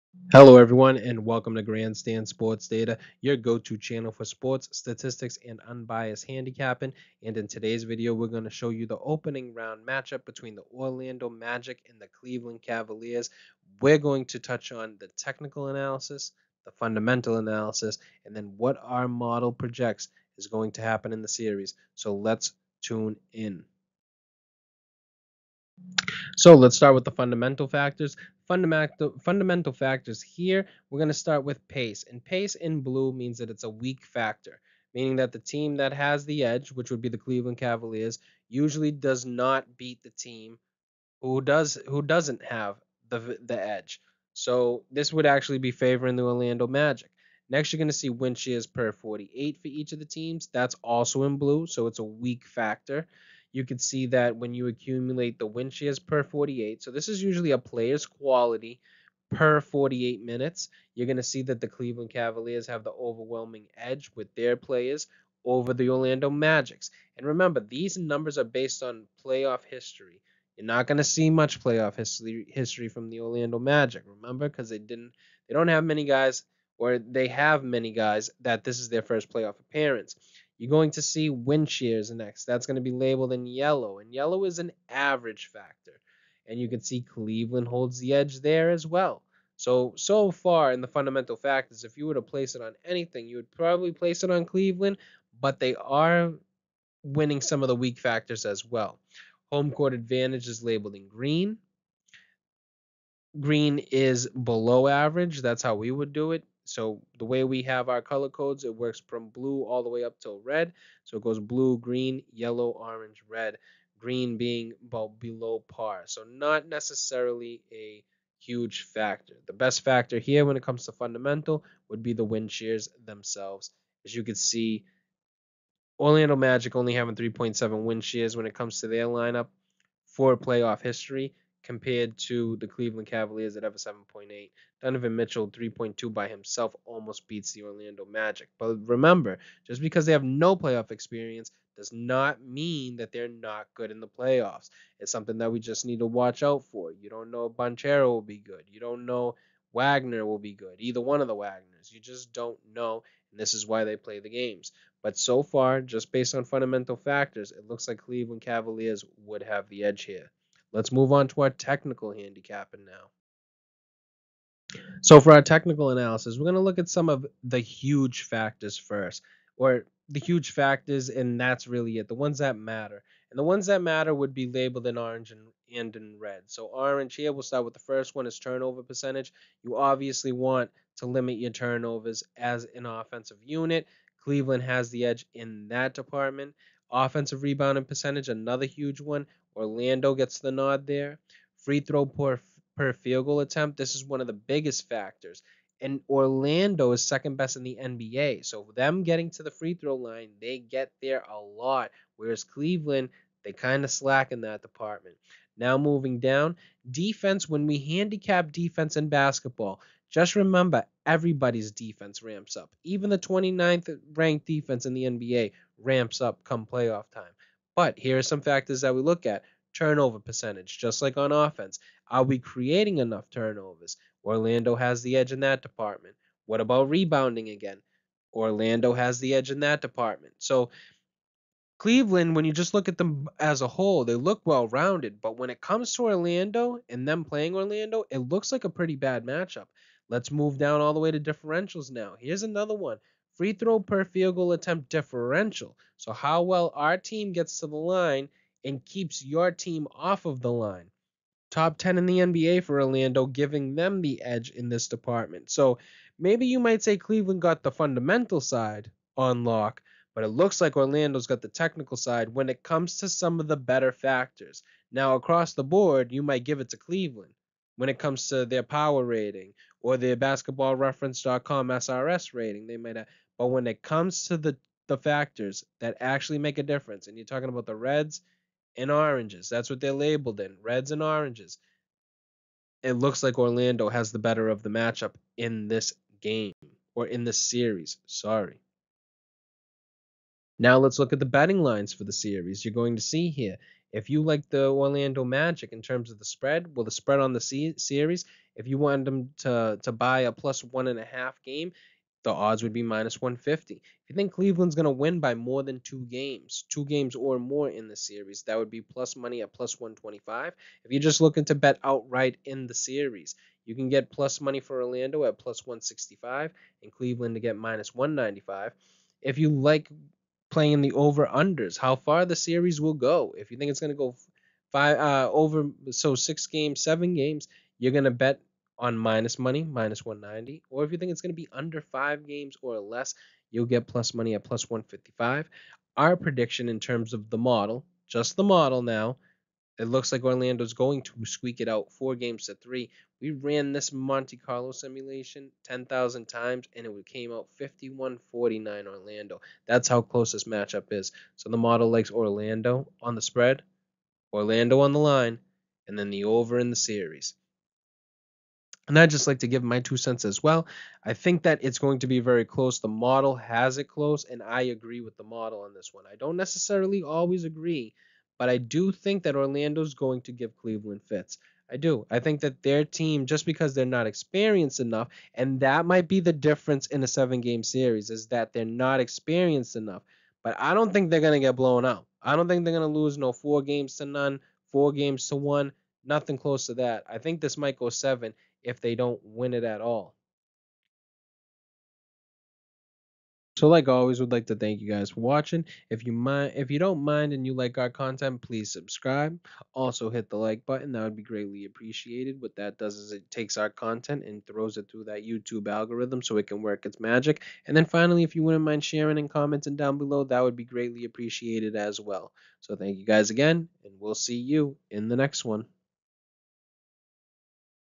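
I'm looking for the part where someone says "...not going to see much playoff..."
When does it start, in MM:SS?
01:10.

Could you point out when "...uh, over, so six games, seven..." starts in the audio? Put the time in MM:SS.
05:24.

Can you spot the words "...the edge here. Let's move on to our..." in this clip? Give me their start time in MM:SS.
02:39.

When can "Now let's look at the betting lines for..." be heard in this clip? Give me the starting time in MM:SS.
04:50.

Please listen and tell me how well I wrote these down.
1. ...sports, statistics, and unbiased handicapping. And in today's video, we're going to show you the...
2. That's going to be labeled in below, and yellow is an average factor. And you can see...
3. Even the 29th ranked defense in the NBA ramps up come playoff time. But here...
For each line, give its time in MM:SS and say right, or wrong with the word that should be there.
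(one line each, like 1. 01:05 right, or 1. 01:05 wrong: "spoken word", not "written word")
1. 00:04 right
2. 01:22 wrong: "yellow", not "below"
3. 03:32 right.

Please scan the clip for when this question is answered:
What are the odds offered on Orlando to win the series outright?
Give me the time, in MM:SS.
05:15.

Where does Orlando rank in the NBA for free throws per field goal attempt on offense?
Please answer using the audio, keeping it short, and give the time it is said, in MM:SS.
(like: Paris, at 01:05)
Second best, at 03:17.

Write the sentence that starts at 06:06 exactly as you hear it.
I don't necessarily always agree, but I do think that Orlando's going to give Cleveland fits.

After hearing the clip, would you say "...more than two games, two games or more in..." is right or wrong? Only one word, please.
right.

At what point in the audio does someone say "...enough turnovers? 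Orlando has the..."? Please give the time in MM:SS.
03:42.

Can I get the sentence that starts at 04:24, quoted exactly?
Now, across the board, you might give it to Cleveland when it comes to their power rating or their basketballreference.com SRS rating.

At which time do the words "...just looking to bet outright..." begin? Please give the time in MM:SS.
05:11.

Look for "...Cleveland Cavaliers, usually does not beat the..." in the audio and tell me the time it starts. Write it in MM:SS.
00:37.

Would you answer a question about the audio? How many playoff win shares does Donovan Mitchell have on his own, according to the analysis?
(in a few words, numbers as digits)
3.2.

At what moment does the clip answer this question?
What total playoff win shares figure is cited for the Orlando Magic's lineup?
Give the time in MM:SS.
02:07.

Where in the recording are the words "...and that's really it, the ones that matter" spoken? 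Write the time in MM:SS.
02:51.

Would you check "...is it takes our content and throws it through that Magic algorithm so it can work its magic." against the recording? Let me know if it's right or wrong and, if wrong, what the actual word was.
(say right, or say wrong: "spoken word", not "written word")
wrong: "YouTube", not "Magic".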